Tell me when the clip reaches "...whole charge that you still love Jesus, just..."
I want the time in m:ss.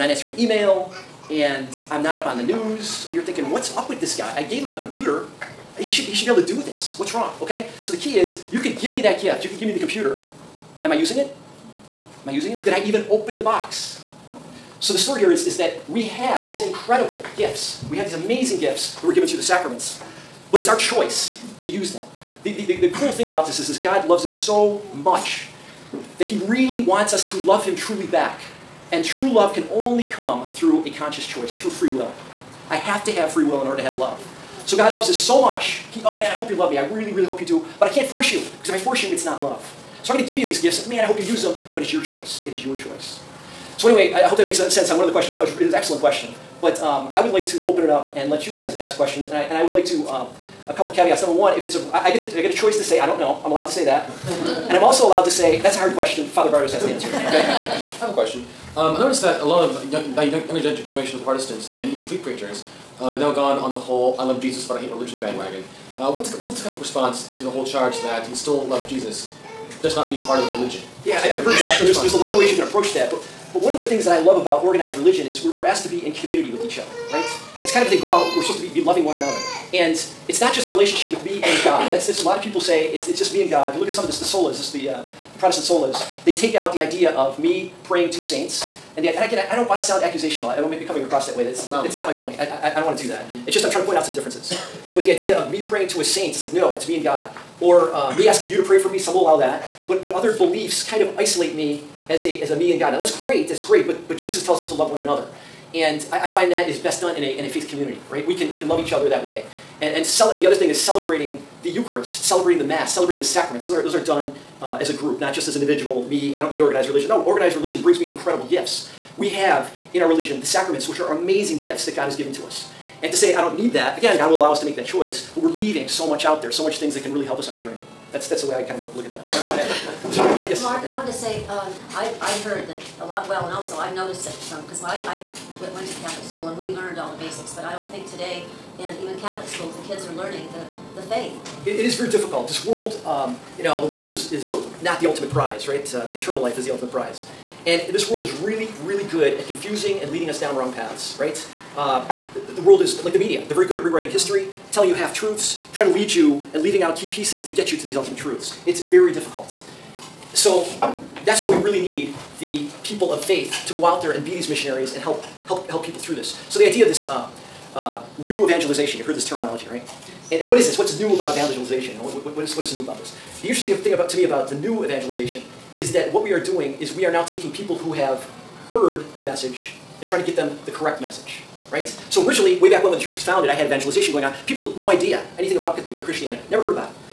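1:07.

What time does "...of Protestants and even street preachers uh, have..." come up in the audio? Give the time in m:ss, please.
1:01.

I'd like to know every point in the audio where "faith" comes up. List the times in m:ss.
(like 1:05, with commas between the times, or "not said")
1:47, 2:21, 2:43.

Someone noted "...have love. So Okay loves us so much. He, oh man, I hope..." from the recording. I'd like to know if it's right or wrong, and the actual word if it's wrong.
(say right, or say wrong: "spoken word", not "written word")
wrong: "God", not "Okay".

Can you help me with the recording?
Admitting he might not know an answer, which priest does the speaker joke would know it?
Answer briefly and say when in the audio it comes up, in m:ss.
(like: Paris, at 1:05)
Father Bartus, at 0:56.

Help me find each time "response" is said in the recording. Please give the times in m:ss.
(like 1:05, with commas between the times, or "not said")
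1:06.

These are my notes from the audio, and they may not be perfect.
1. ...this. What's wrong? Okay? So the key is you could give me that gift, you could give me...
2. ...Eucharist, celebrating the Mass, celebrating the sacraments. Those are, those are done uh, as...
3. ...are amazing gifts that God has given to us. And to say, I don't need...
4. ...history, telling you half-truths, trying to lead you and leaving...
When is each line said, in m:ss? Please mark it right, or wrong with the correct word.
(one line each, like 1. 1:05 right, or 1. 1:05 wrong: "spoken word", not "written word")
1. 0:06 right
2. 1:51 right
3. 2:00 right
4. 2:34 right.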